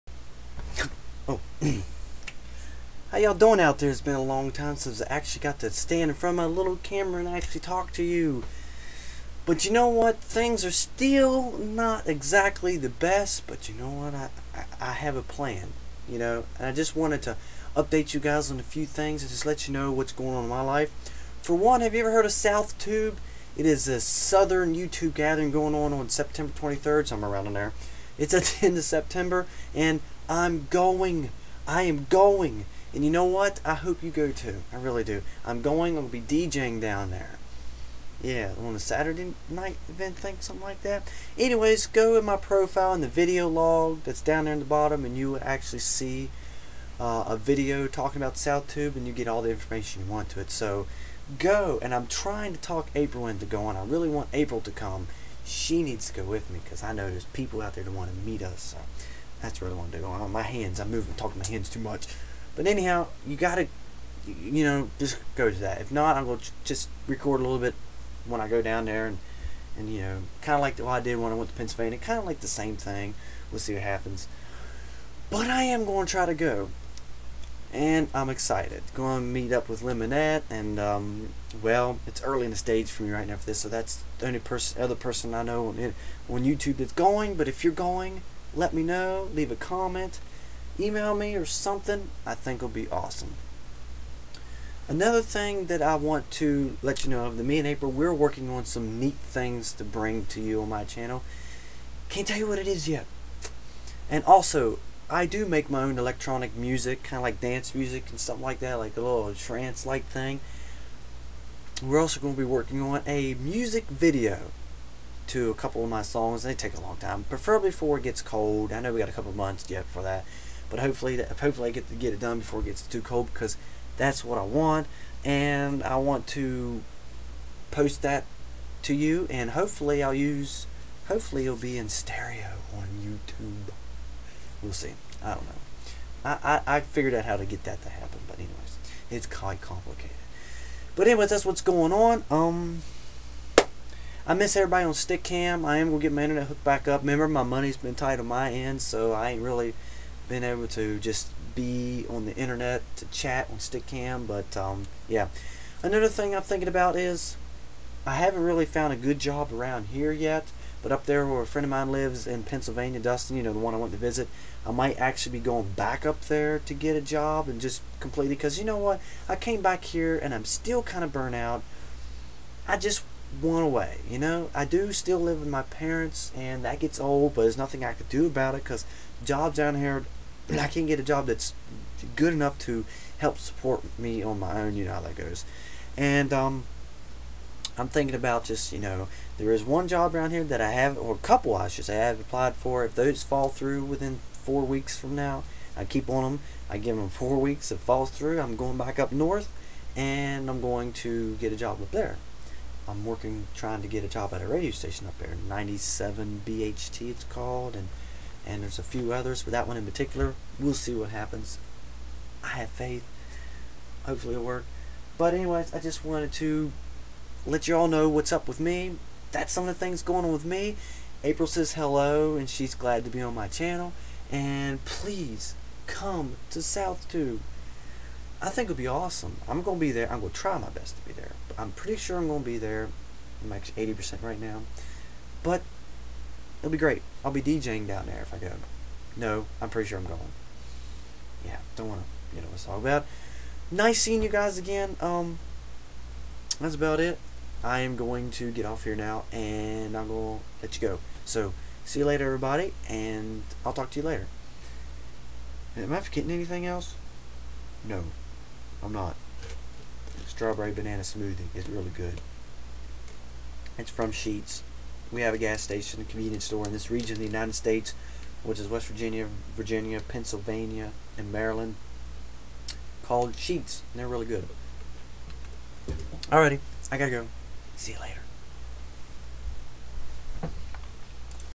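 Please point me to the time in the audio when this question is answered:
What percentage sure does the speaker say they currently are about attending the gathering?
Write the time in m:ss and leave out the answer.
3:53.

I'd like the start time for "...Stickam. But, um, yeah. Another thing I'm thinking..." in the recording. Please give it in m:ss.
2:33.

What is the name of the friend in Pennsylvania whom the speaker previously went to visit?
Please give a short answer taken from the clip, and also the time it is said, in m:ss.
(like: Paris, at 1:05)
Dustin, at 2:43.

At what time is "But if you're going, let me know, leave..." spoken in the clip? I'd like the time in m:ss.
1:27.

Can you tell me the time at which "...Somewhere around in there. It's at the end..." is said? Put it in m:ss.
0:27.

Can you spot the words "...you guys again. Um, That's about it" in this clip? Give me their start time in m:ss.
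4:04.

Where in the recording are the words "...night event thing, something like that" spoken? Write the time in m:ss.
0:39.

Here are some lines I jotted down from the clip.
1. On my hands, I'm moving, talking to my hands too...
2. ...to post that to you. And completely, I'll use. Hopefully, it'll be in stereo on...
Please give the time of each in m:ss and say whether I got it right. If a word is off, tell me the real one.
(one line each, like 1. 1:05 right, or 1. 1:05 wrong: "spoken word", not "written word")
1. 1:00 right
2. 2:06 wrong: "hopefully", not "completely".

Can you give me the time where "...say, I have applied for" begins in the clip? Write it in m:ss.
3:11.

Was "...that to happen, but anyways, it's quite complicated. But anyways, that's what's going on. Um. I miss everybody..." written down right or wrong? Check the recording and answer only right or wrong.
right.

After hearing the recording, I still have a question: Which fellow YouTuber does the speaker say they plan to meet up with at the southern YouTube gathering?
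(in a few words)
Lemonette.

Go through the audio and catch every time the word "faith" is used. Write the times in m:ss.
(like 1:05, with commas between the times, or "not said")
3:32.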